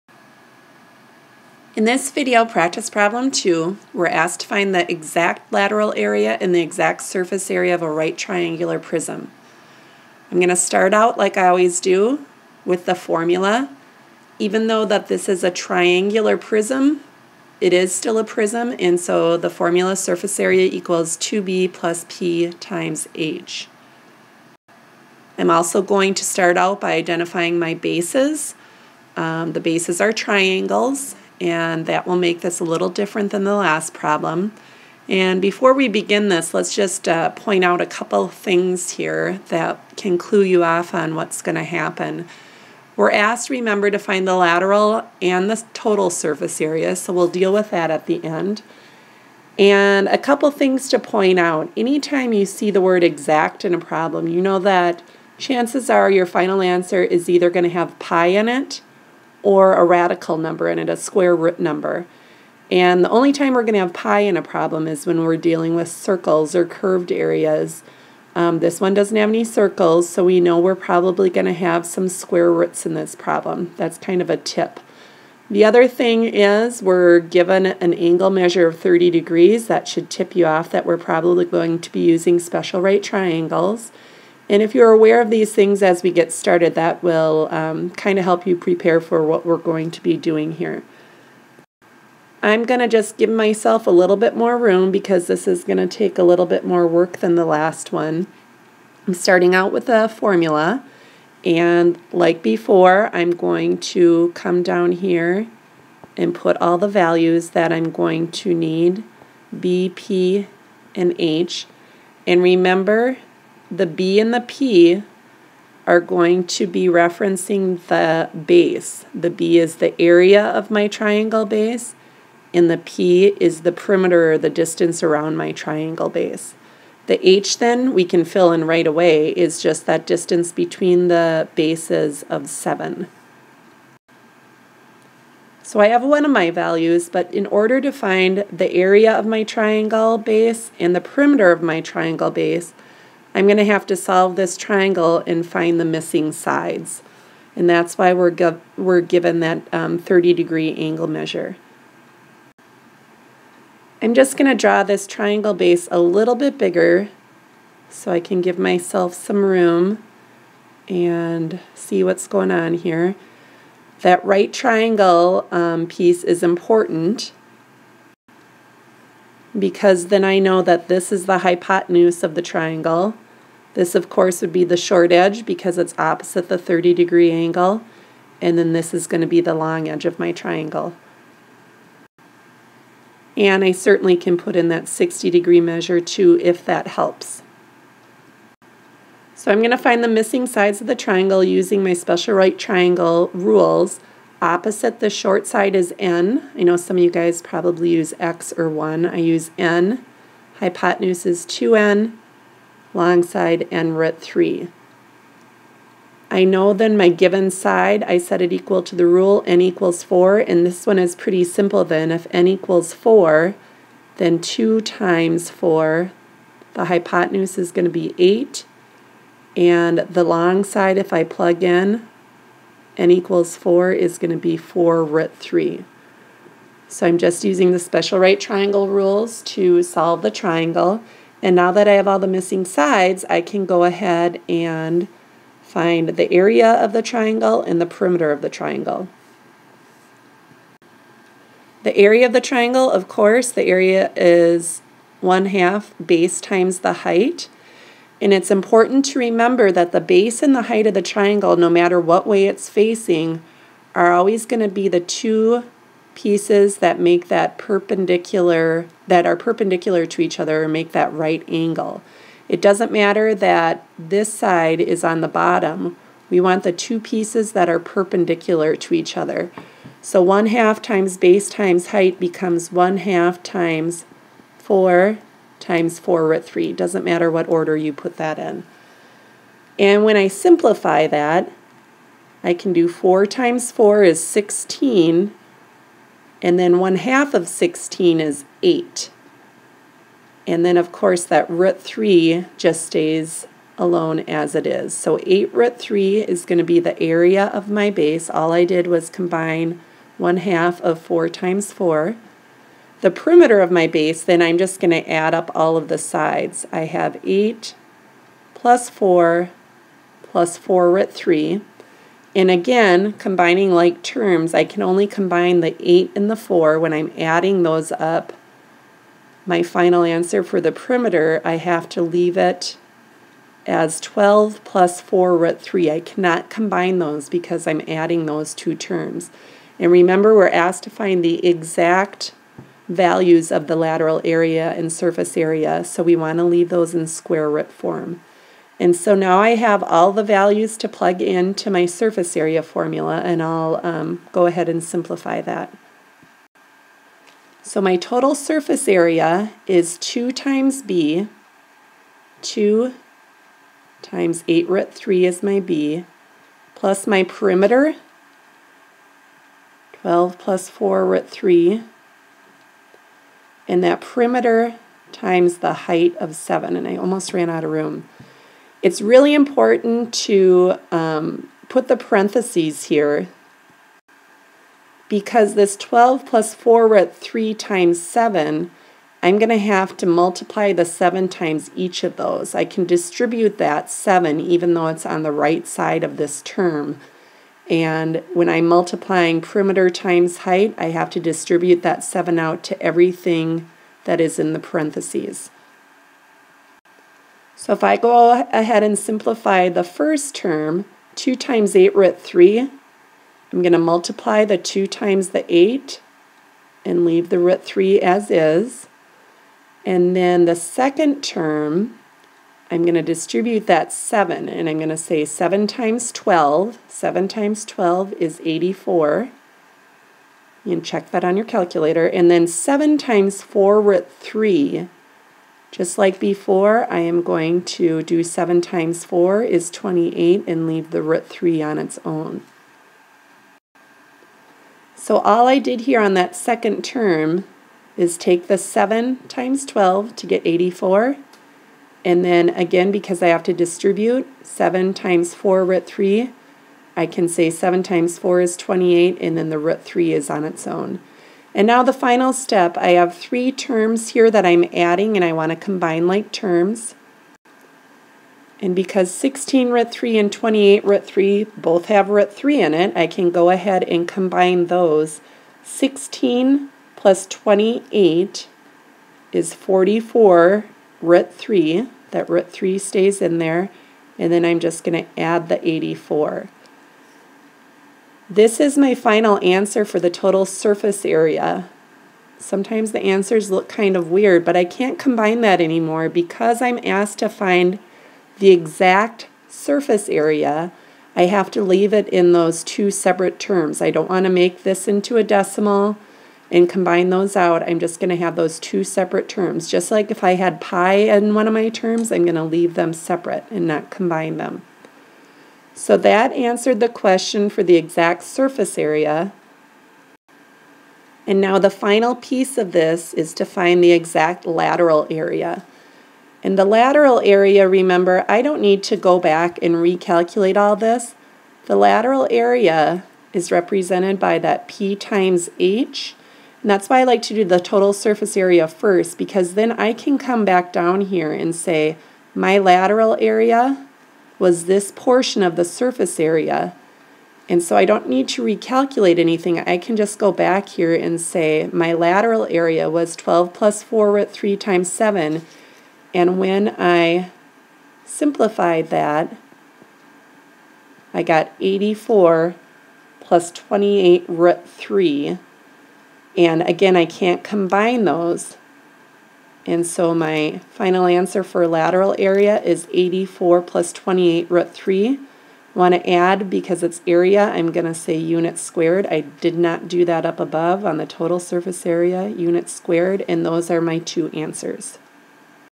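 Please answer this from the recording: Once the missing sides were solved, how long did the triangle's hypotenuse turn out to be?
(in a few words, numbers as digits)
8.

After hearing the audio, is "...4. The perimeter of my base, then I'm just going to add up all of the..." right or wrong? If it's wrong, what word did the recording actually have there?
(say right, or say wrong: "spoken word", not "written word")
right.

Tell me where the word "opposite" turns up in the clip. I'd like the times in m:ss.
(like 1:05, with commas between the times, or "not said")
2:55, 3:14.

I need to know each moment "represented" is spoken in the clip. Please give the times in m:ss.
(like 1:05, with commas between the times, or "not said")
8:43.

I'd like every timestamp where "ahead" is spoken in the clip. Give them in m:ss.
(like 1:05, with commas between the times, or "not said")
3:53, 5:44, 6:38, 7:43.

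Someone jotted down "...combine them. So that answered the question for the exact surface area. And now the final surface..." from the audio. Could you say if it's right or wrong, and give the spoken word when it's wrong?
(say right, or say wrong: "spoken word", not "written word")
wrong: "piece", not "surface".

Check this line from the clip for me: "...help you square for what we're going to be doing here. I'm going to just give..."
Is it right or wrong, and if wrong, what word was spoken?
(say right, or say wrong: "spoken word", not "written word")
wrong: "prepare", not "square".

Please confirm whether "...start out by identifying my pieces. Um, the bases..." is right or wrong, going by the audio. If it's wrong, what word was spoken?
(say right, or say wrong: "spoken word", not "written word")
wrong: "bases", not "pieces".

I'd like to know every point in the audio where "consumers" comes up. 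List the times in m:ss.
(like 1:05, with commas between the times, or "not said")
not said.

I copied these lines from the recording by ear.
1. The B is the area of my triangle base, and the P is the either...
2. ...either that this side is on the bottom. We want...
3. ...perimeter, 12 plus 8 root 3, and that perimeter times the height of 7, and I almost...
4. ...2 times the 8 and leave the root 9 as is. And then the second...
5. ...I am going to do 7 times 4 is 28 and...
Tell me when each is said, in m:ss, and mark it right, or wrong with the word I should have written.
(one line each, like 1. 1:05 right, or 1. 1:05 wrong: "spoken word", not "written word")
1. 1:59 wrong: "perimeter", not "either"
2. 4:22 wrong: "matter", not "either"
3. 5:57 wrong: "4", not "8"
4. 6:44 wrong: "3", not "9"
5. 7:06 right.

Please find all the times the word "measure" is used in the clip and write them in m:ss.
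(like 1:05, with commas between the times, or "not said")
1:18, 2:31, 3:05.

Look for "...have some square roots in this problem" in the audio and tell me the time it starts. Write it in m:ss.
1:11.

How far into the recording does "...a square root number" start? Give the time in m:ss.
1:00.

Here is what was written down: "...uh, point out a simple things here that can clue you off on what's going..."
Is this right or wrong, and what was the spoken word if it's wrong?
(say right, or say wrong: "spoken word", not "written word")
wrong: "couple", not "simple".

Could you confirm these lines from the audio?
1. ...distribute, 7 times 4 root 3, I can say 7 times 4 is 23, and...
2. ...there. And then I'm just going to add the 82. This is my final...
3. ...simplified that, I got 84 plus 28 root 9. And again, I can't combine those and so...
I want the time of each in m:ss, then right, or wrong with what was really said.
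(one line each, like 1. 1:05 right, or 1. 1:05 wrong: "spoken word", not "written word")
1. 7:23 wrong: "28", not "23"
2. 7:53 wrong: "84", not "82"
3. 9:08 wrong: "3", not "9".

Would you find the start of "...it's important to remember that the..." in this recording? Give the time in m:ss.
4:08.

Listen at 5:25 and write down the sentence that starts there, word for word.
I cannot combine those because I'm adding those two terms.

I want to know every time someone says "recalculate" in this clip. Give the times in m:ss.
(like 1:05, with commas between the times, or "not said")
8:39, 8:58.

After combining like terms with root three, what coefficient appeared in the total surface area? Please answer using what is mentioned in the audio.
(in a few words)
44.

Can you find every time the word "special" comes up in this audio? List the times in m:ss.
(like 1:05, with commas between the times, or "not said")
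1:22, 3:11, 3:47.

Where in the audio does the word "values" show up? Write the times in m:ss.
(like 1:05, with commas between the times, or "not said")
1:46, 2:16, 5:32, 5:40.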